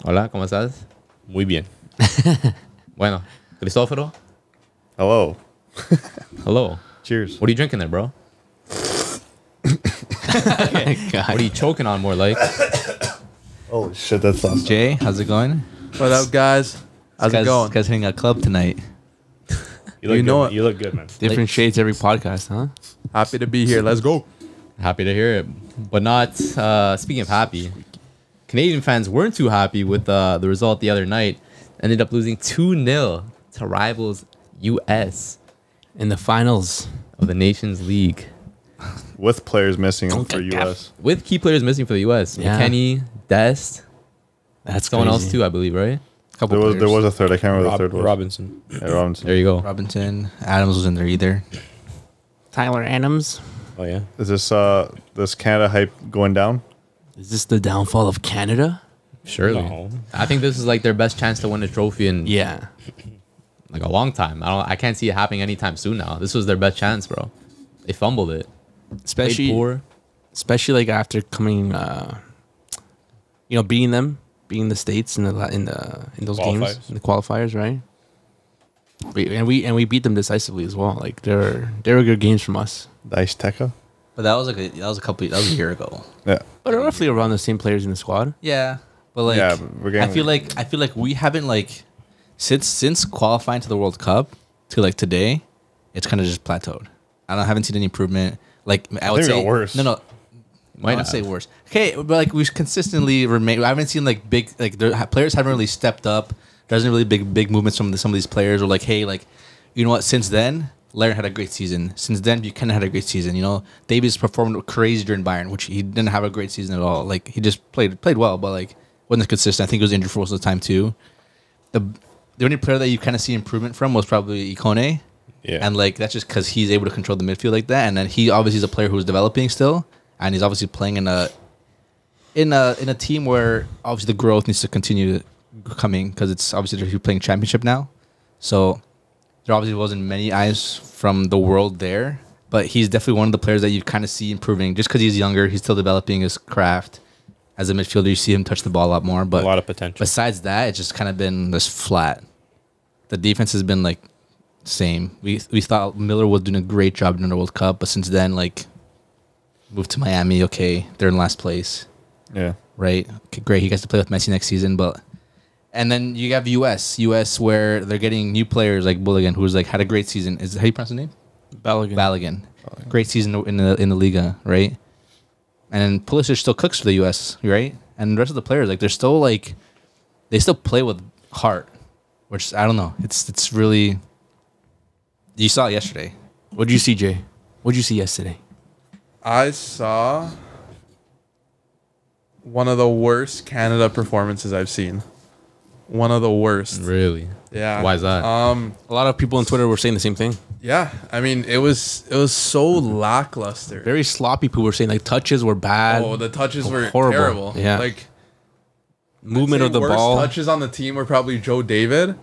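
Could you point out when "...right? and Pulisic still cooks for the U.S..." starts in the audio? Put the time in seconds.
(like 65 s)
174 s.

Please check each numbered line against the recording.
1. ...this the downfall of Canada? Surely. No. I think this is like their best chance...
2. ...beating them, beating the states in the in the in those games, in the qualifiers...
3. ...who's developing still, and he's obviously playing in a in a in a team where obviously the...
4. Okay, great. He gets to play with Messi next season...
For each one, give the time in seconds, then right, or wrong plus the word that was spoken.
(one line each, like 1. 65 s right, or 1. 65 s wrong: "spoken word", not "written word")
1. 57 s right
2. 73 s right
3. 128 s right
4. 163 s right.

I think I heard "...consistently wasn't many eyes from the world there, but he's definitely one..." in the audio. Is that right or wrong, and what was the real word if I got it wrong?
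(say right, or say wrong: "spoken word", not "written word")
wrong: "obviously", not "consistently".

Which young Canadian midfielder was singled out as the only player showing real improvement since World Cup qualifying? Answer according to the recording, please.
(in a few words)
Ikone.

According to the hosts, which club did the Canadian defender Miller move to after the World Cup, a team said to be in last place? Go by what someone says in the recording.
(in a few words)
Miami.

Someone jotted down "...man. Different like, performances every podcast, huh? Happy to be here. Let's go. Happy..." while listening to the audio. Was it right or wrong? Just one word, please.
wrong.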